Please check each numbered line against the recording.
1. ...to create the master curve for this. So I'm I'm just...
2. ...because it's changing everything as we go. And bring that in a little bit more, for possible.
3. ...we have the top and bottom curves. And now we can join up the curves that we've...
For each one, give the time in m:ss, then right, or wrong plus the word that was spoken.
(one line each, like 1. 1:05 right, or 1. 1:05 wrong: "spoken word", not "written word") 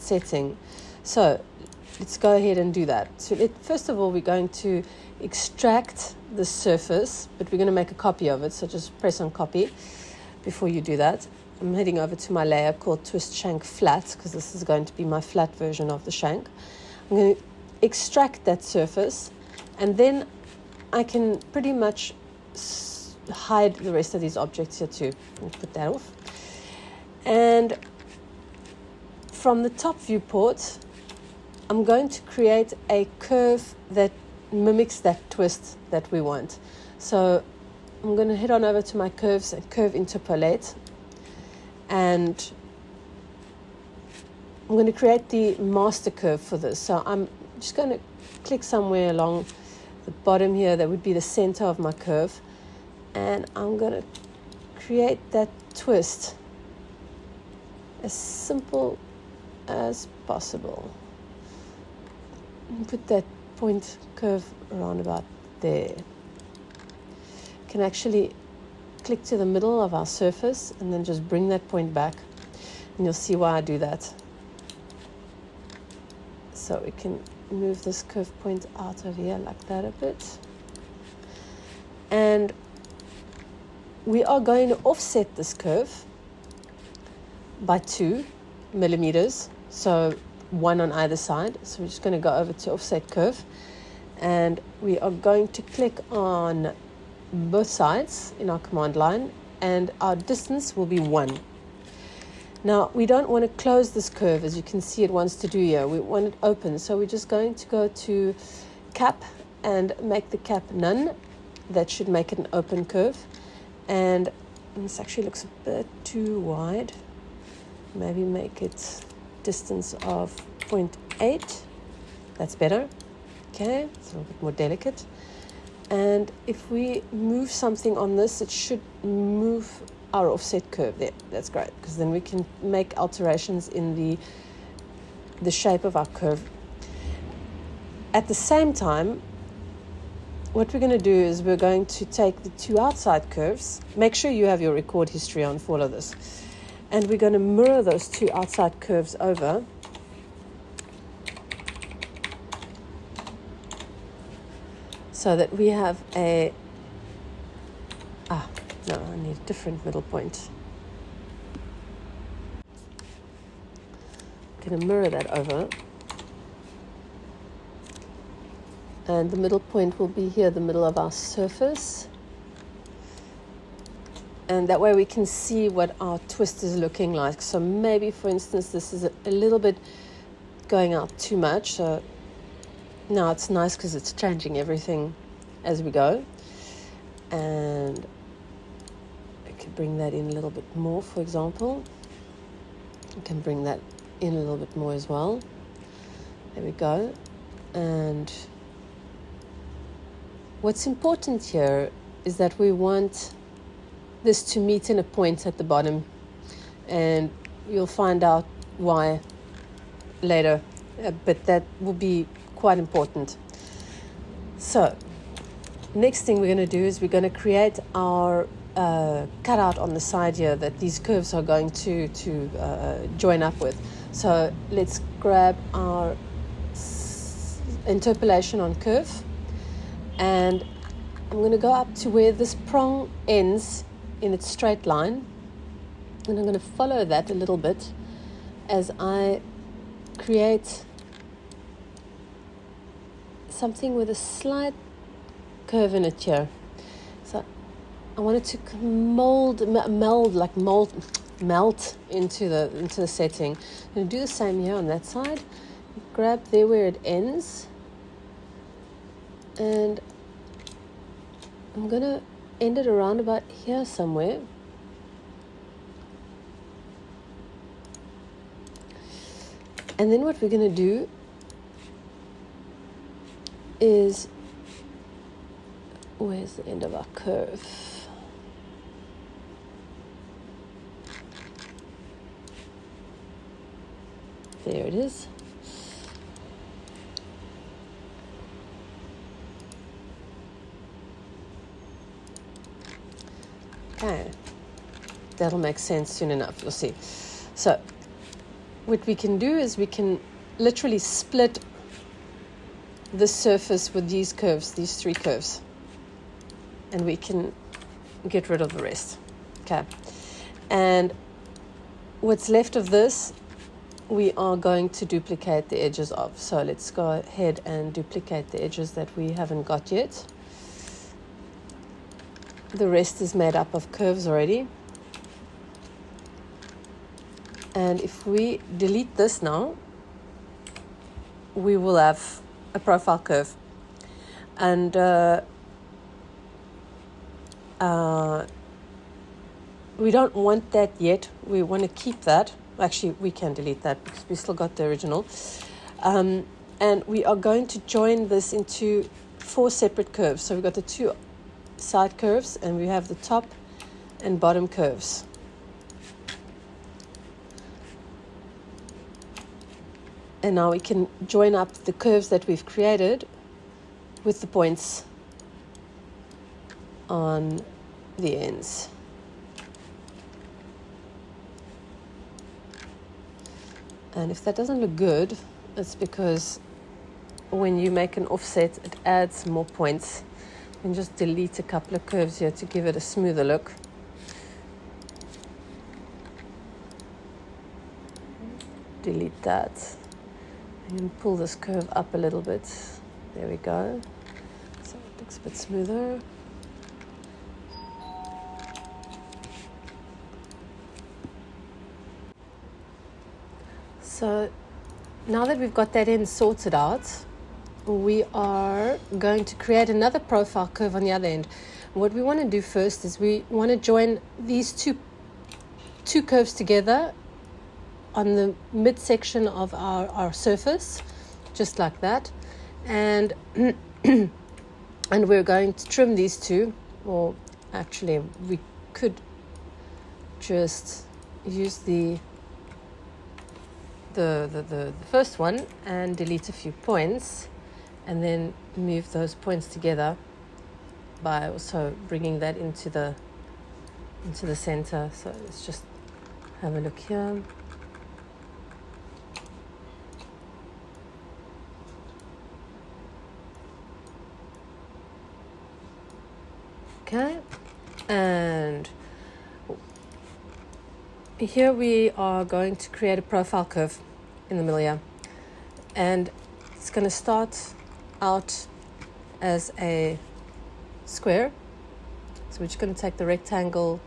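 1. 0:44 right
2. 3:03 wrong: "example", not "possible"
3. 5:52 right.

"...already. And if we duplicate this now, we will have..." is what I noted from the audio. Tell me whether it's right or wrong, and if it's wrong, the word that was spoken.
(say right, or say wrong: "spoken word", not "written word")
wrong: "delete", not "duplicate".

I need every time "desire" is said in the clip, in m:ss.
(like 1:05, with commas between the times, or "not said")
not said.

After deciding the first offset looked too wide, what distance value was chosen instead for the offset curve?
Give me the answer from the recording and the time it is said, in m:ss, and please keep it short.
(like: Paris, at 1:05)
0.8, at 2:00.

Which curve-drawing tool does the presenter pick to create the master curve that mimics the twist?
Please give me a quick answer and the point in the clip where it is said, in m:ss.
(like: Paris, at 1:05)
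Curve interpolate, at 0:39.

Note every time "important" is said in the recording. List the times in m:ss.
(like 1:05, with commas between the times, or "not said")
3:20, 3:32.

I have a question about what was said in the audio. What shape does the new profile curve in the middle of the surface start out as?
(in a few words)
A square.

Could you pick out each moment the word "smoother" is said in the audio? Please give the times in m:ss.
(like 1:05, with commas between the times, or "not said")
6:23, 6:35.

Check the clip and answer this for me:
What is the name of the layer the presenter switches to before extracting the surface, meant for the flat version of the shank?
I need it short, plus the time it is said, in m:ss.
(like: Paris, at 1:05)
Twist Shank Flat, at 0:13.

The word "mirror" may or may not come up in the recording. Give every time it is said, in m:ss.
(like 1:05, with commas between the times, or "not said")
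2:27, 2:44.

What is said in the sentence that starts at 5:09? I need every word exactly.
Okay, and what's left of this we are going to duplicate the edges of.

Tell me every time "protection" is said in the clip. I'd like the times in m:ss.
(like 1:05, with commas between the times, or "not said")
not said.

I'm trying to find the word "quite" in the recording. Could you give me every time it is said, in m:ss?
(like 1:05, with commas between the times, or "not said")
3:32.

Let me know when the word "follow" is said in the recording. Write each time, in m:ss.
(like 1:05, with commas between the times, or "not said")
3:56.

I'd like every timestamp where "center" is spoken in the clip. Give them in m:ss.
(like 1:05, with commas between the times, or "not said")
0:51, 7:24.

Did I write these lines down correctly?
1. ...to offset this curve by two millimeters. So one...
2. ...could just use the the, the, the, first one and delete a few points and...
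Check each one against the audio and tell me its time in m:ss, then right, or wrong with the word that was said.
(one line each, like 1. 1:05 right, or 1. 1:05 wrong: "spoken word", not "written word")
1. 1:24 right
2. 7:08 right.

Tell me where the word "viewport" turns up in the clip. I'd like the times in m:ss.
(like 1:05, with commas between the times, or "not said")
0:30.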